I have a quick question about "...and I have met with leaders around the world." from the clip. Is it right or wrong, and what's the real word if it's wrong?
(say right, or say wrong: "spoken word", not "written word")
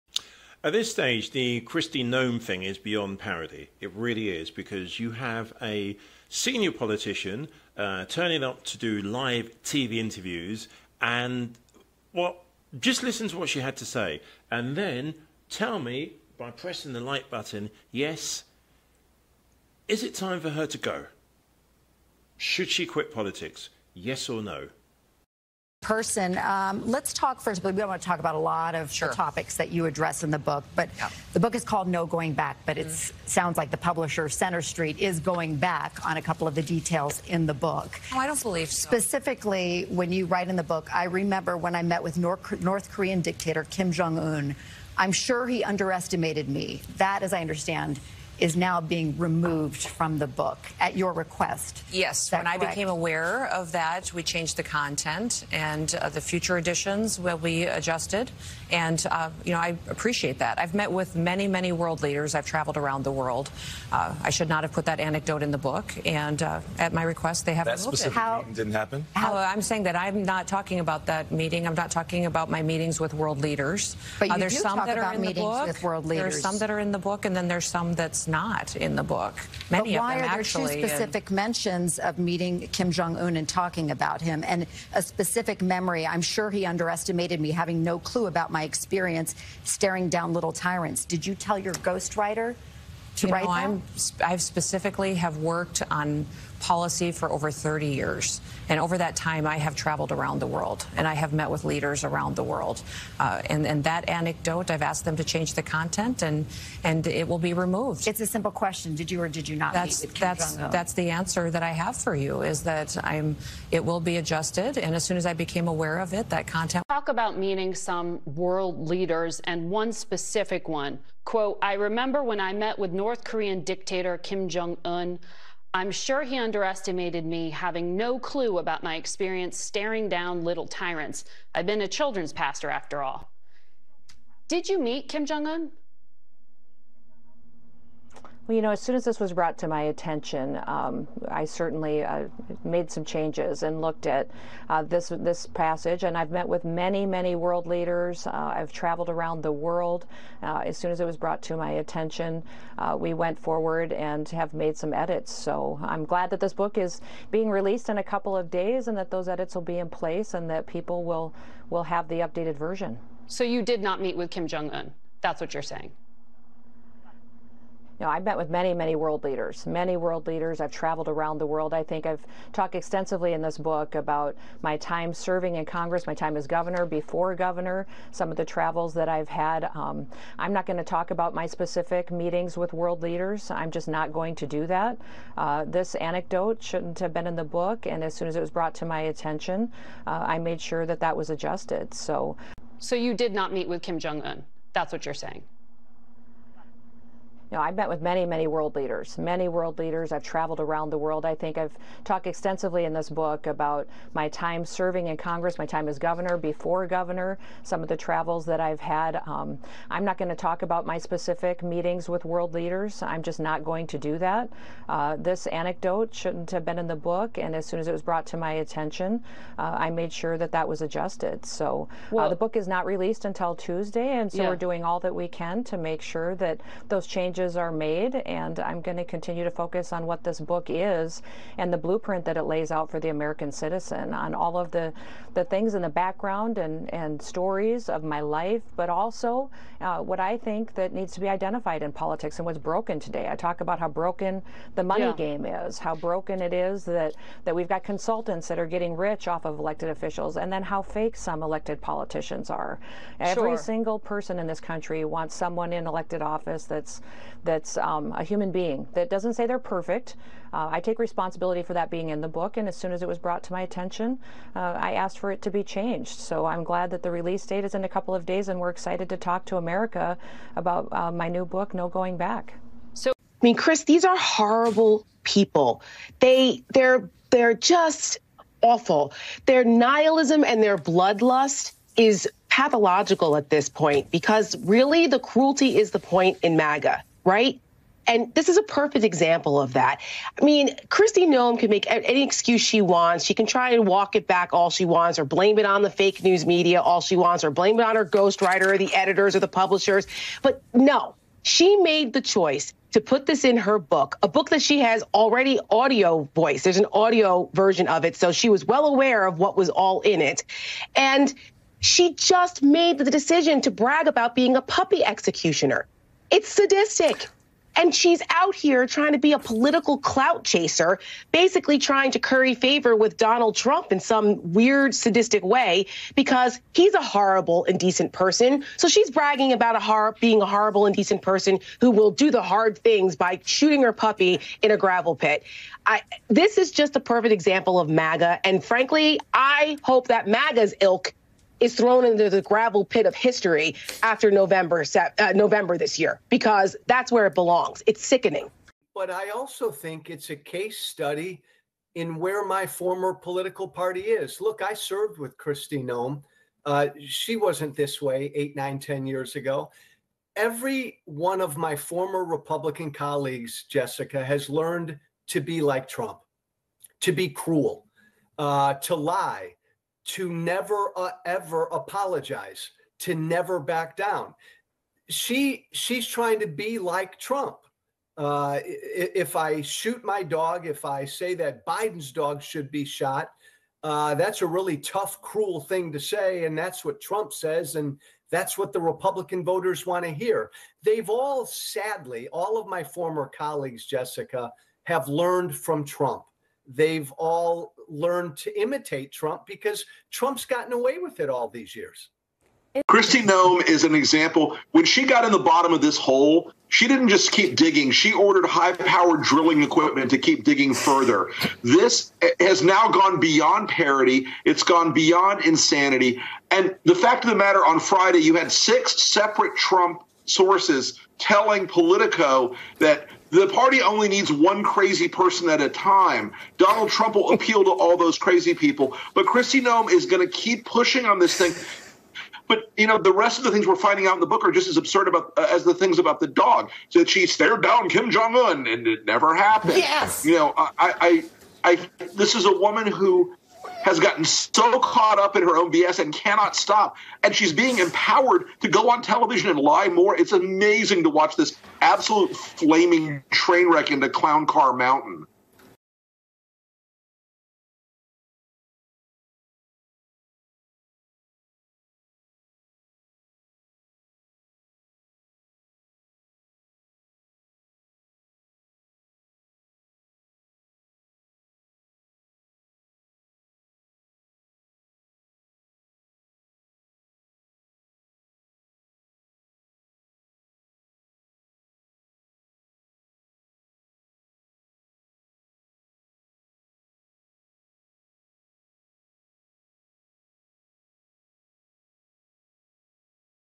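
right.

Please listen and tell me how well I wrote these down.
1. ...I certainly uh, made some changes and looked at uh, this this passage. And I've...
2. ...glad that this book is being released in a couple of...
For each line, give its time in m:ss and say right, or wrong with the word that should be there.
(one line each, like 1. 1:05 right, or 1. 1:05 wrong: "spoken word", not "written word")
1. 2:21 right
2. 2:36 right.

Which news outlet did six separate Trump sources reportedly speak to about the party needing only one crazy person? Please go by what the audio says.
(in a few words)
Politico.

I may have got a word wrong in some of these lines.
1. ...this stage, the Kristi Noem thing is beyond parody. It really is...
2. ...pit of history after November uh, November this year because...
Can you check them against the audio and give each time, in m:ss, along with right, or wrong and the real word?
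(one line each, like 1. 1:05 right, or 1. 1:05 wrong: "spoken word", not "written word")
1. 0:00 right
2. 5:42 right.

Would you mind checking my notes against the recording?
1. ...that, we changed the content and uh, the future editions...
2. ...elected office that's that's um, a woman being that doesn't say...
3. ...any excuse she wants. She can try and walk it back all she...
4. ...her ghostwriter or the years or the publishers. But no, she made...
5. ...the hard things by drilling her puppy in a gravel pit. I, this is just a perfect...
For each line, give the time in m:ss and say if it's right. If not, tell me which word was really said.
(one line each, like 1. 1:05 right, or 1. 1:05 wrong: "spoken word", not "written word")
1. 0:53 right
2. 4:15 wrong: "human", not "woman"
3. 4:51 right
4. 4:57 wrong: "editors", not "years"
5. 5:32 wrong: "shooting", not "drilling".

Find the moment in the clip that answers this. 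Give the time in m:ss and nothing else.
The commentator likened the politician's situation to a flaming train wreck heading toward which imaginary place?
7:34.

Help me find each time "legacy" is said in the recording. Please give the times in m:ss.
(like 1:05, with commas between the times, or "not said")
not said.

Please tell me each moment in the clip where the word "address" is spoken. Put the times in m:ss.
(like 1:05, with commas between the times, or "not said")
0:29.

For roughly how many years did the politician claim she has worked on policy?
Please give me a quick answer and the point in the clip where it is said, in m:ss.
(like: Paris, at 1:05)
30, at 1:37.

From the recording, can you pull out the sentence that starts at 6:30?
They've all, sadly, all of my former colleagues, Jessica, have learned from Trump.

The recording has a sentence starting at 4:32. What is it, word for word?
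So, I mean, Chris, these are horrible people.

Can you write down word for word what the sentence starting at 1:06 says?
And uh, at my request, they have that removed it.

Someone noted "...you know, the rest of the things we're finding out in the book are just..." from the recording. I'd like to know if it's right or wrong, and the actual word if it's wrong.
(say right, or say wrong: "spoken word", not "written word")
right.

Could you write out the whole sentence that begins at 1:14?
But uh, you there's do some talk that about are in meetings the book.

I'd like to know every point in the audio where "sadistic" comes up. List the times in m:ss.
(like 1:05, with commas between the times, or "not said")
5:16, 5:24.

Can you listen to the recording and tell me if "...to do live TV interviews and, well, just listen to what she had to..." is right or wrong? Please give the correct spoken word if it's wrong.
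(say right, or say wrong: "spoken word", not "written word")
right.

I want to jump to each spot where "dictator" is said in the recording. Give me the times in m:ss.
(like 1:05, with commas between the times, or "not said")
0:43, 2:03.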